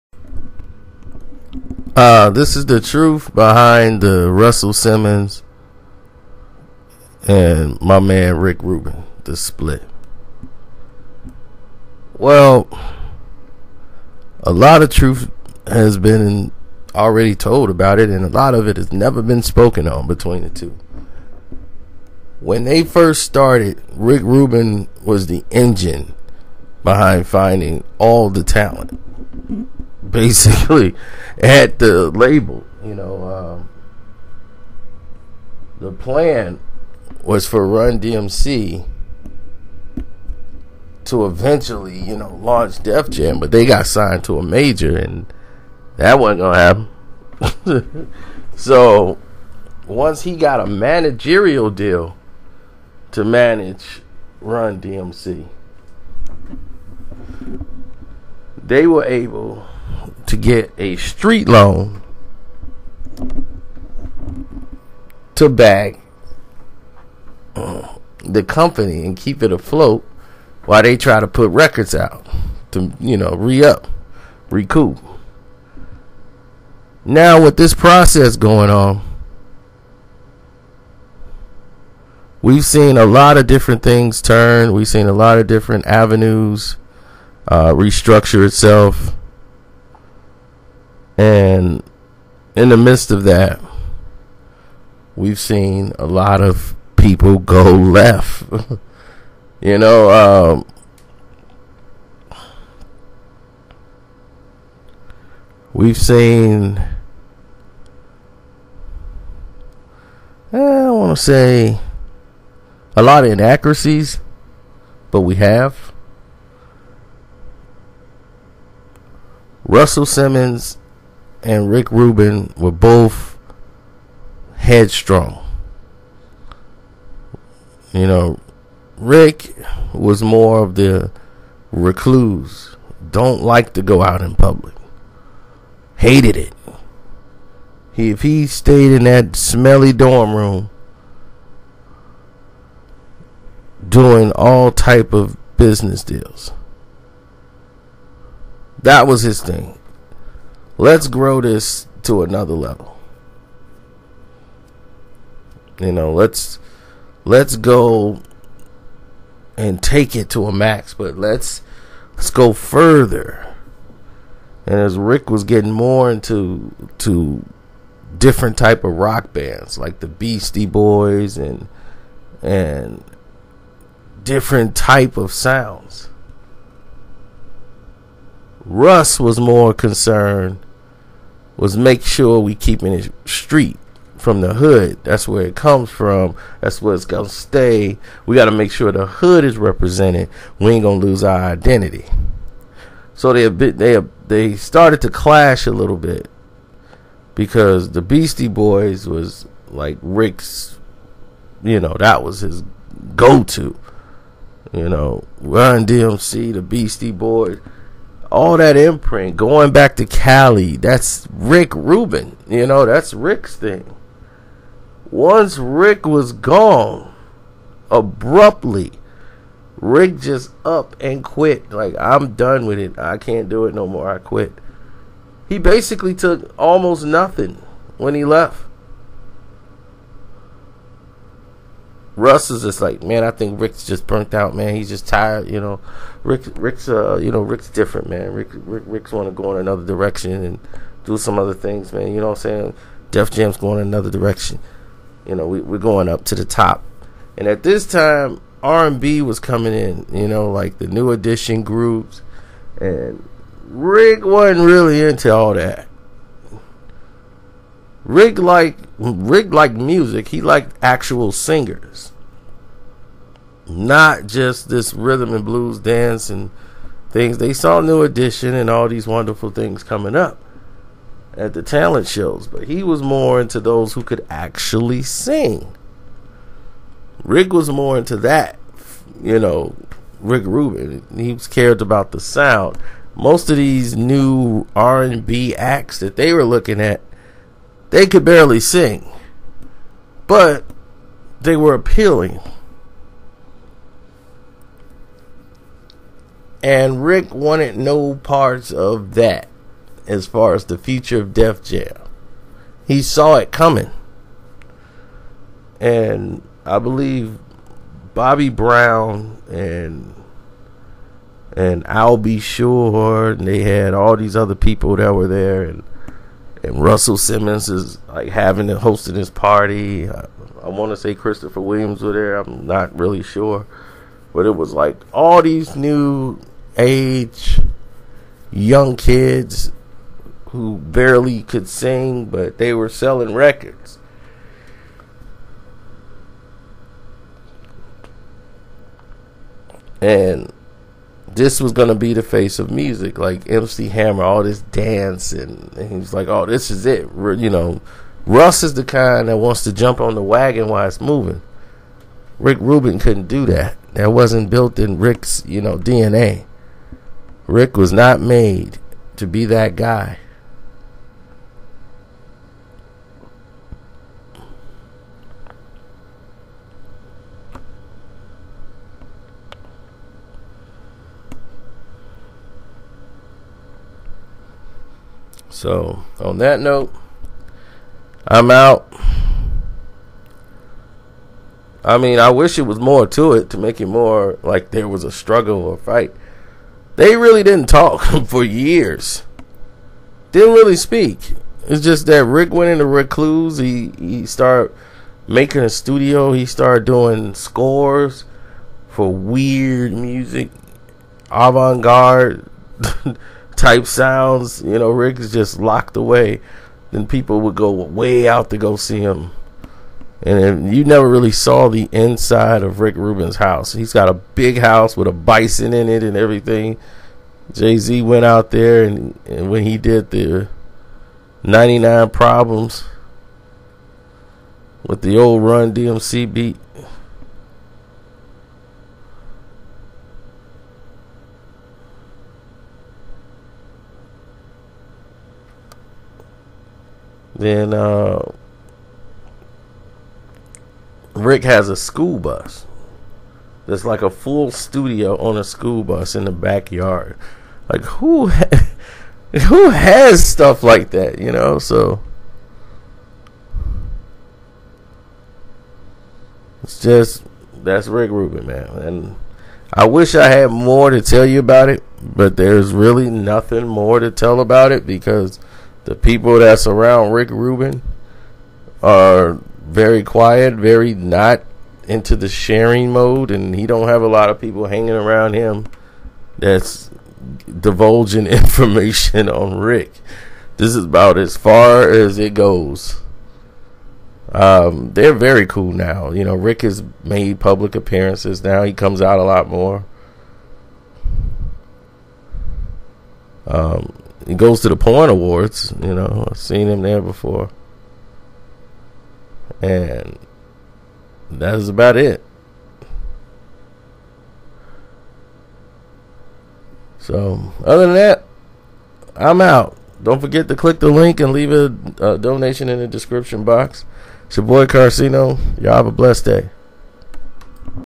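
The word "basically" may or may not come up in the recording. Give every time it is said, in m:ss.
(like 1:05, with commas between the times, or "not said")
0:30, 3:45.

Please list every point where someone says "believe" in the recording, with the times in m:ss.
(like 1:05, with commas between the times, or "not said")
5:06.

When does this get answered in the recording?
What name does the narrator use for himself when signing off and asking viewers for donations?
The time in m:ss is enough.
8:34.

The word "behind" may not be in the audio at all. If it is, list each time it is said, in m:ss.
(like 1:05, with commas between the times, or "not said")
0:03, 0:26.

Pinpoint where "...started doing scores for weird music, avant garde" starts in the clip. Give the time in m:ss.
6:36.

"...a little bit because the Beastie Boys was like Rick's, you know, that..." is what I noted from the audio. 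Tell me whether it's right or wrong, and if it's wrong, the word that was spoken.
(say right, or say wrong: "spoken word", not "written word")
right.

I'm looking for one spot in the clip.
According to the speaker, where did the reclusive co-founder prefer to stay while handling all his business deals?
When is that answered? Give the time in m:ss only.
2:19.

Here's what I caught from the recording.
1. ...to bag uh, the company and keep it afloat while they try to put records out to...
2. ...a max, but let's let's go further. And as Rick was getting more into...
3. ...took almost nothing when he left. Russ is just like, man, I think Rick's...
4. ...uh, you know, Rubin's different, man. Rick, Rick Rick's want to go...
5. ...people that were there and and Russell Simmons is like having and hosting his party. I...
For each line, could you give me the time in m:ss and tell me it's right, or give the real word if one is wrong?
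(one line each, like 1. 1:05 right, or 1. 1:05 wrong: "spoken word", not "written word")
1. 1:05 right
2. 2:40 right
3. 3:46 right
4. 3:56 wrong: "Rick", not "Rubin"
5. 5:14 right.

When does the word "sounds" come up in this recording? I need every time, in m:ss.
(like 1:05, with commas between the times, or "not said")
2:55, 4:42, 6:43.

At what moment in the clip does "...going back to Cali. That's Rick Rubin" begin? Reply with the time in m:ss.
3:29.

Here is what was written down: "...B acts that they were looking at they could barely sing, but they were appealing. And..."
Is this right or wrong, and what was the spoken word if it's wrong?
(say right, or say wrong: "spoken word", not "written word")
right.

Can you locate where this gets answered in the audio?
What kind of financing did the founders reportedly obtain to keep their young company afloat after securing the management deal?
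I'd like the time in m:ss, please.
1:00.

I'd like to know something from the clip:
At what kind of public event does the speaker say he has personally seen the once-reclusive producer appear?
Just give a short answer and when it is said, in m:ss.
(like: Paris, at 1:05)
porn awards, at 8:14.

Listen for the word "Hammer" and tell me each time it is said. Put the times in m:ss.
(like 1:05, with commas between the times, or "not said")
5:43.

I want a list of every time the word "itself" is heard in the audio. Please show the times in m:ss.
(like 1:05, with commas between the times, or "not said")
1:28.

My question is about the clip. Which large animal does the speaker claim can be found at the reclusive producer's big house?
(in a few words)
bison.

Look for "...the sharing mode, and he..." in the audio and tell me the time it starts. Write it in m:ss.
7:52.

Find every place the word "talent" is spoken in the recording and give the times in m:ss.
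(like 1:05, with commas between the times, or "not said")
0:28, 4:31.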